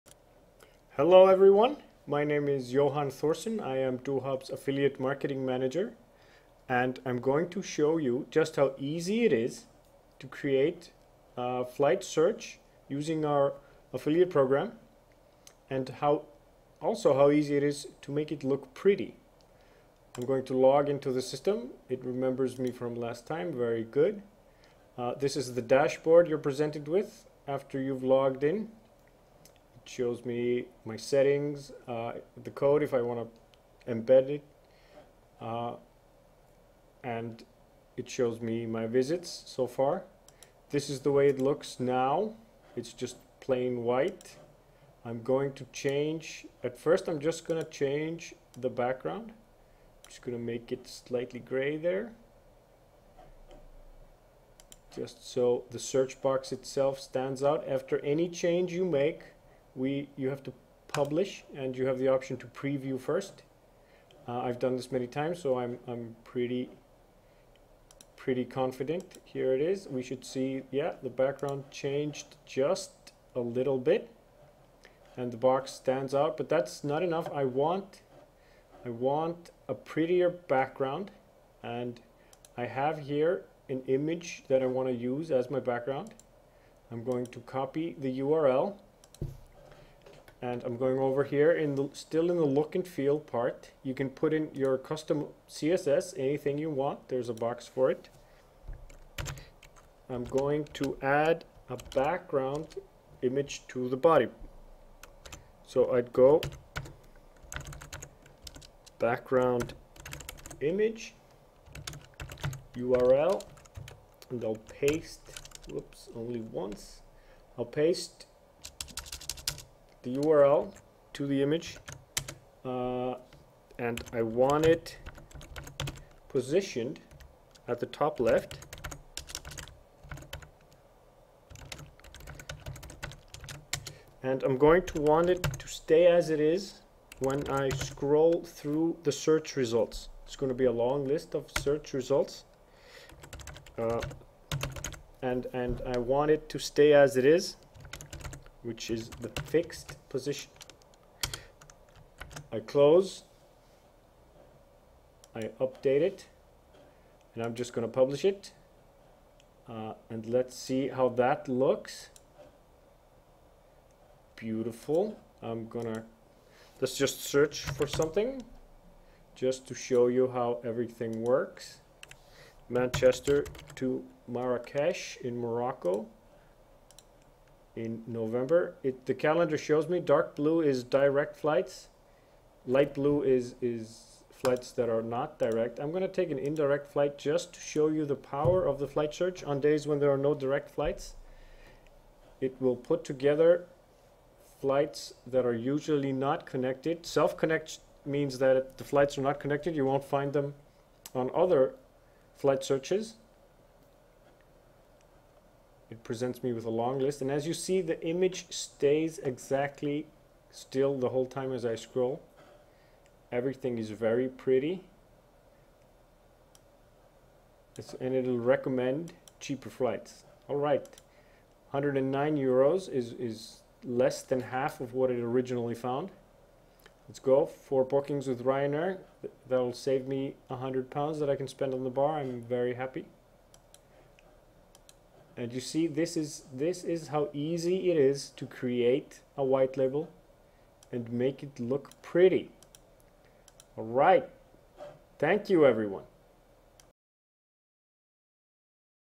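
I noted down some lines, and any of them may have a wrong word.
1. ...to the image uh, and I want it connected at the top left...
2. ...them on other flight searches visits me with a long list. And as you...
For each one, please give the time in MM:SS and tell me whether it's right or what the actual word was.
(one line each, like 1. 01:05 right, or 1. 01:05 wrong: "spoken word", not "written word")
1. 02:01 wrong: "positioned", not "connected"
2. 03:20 wrong: "presents", not "visits".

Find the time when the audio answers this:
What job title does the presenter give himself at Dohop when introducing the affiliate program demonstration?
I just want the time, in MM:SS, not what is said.
00:04.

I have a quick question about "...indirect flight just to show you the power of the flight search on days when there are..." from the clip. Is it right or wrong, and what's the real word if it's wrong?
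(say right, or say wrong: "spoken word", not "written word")
right.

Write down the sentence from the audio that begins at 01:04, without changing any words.
Uh, I've done this many times, so I'm, I'm pretty pretty confident.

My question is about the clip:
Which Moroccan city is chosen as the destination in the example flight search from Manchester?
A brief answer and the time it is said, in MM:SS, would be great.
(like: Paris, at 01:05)
Marrakesh, at 02:54.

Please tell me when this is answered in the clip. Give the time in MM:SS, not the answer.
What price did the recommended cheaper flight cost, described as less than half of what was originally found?
03:41.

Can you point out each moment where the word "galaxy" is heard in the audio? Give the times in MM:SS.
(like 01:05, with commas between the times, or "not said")
not said.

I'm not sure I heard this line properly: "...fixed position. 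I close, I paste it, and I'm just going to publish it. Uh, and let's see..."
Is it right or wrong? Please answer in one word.
wrong.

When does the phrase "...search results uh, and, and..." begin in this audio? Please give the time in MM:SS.
02:21.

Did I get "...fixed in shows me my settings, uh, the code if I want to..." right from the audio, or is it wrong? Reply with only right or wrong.
wrong.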